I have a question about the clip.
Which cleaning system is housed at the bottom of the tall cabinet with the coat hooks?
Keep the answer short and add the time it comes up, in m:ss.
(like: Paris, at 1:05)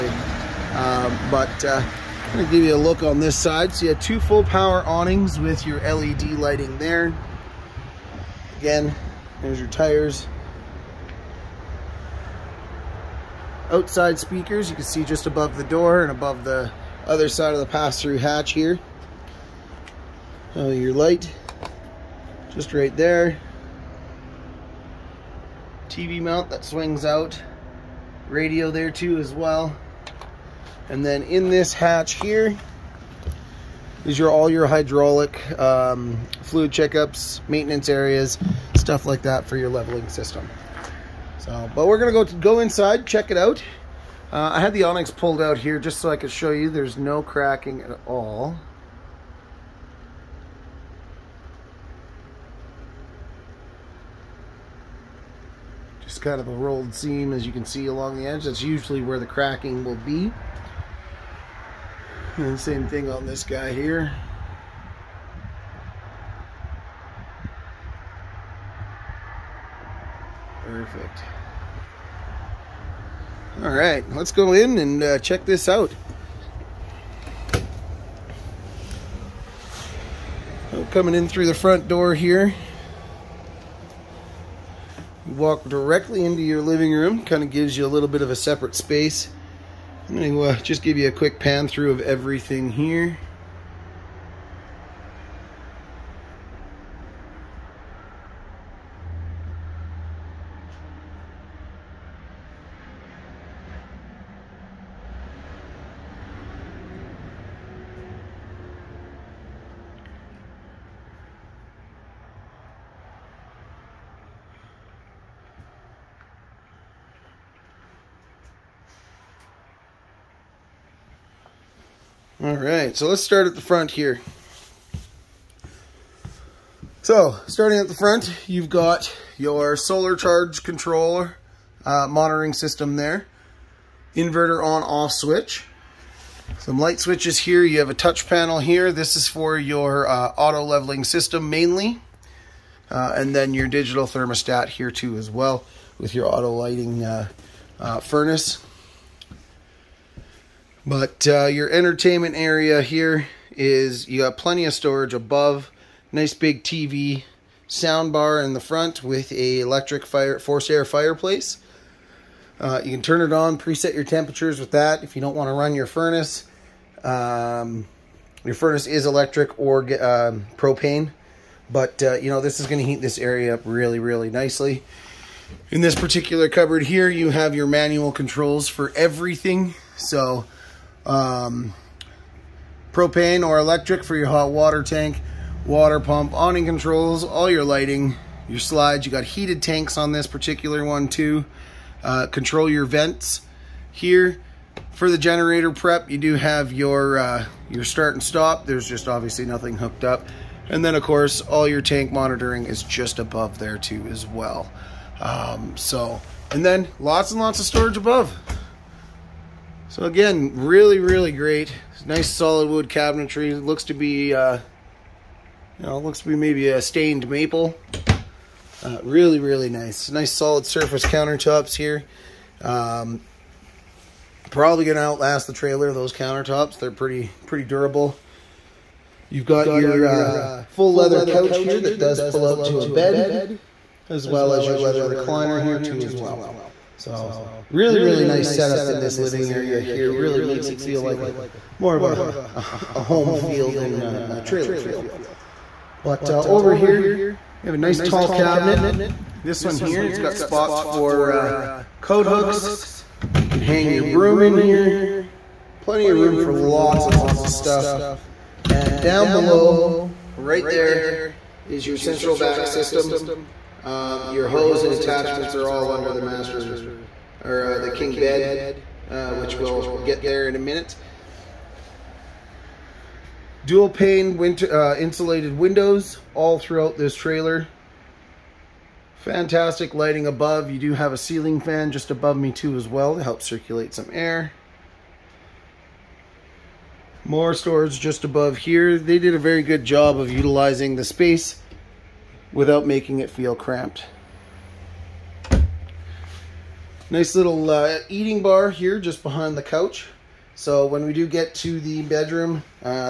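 central vac system, at 4:21.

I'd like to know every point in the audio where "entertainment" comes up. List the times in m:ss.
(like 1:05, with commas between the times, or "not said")
2:31.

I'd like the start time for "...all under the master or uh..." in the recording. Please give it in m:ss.
4:25.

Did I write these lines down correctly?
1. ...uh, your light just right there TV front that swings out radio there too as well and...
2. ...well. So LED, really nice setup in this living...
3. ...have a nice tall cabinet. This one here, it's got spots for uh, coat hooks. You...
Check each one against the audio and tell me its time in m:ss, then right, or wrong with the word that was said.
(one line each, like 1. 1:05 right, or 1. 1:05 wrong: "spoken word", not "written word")
1. 0:20 wrong: "mount", not "front"
2. 3:56 wrong: "Really", not "LED"
3. 4:07 right.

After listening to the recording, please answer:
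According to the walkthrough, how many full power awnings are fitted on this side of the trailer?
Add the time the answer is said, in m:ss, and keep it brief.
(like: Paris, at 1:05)
2, at 0:04.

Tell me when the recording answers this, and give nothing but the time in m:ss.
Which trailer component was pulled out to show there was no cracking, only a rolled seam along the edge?
0:44.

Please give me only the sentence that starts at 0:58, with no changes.
That's usually where the cracking will be.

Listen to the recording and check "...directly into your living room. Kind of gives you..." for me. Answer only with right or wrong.
right.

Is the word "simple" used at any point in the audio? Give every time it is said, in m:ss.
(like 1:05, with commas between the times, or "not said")
not said.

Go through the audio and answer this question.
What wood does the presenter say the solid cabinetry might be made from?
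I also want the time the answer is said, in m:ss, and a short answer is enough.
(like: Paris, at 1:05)
stained maple, at 3:36.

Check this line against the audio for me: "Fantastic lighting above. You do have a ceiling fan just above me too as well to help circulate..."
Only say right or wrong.
right.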